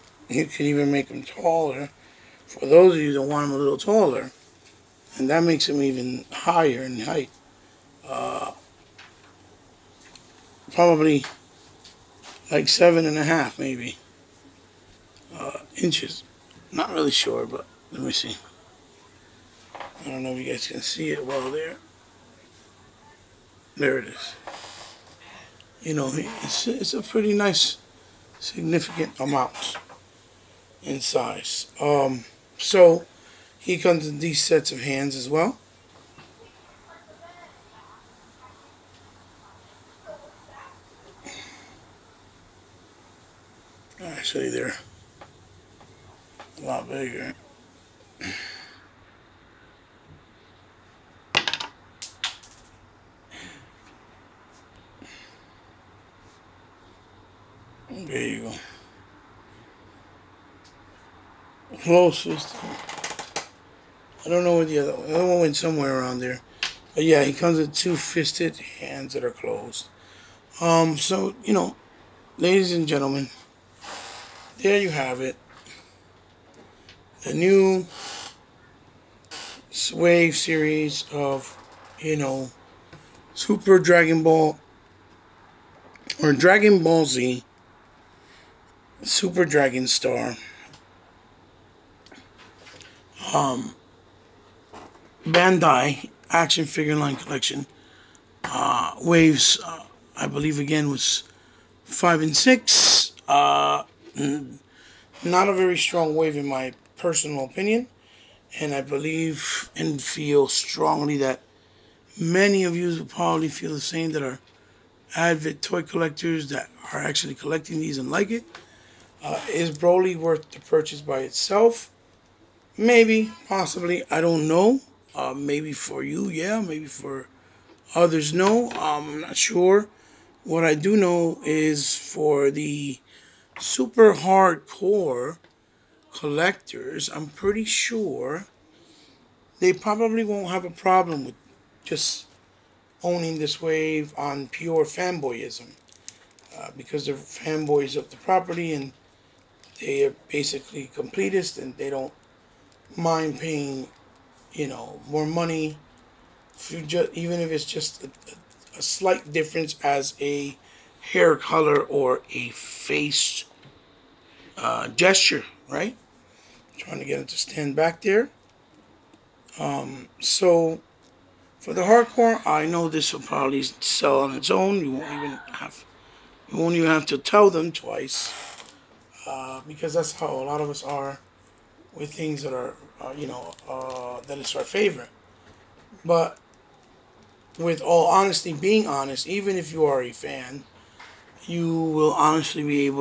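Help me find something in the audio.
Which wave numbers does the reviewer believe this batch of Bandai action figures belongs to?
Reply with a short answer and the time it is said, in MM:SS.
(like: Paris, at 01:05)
5 and 6, at 01:41.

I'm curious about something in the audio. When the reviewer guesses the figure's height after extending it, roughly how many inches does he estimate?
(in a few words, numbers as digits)
7.5 inches.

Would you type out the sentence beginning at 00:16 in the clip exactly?
Not really sure, but let me see.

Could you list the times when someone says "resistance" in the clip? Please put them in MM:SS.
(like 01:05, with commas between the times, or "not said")
not said.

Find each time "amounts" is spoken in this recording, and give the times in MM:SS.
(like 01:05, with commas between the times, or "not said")
00:29.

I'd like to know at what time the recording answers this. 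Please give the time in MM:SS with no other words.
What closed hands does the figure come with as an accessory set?
01:07.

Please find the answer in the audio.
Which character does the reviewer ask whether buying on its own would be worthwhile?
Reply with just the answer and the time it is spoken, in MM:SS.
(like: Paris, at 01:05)
Broly, at 01:59.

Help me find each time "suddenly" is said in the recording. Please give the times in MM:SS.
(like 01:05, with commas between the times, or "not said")
not said.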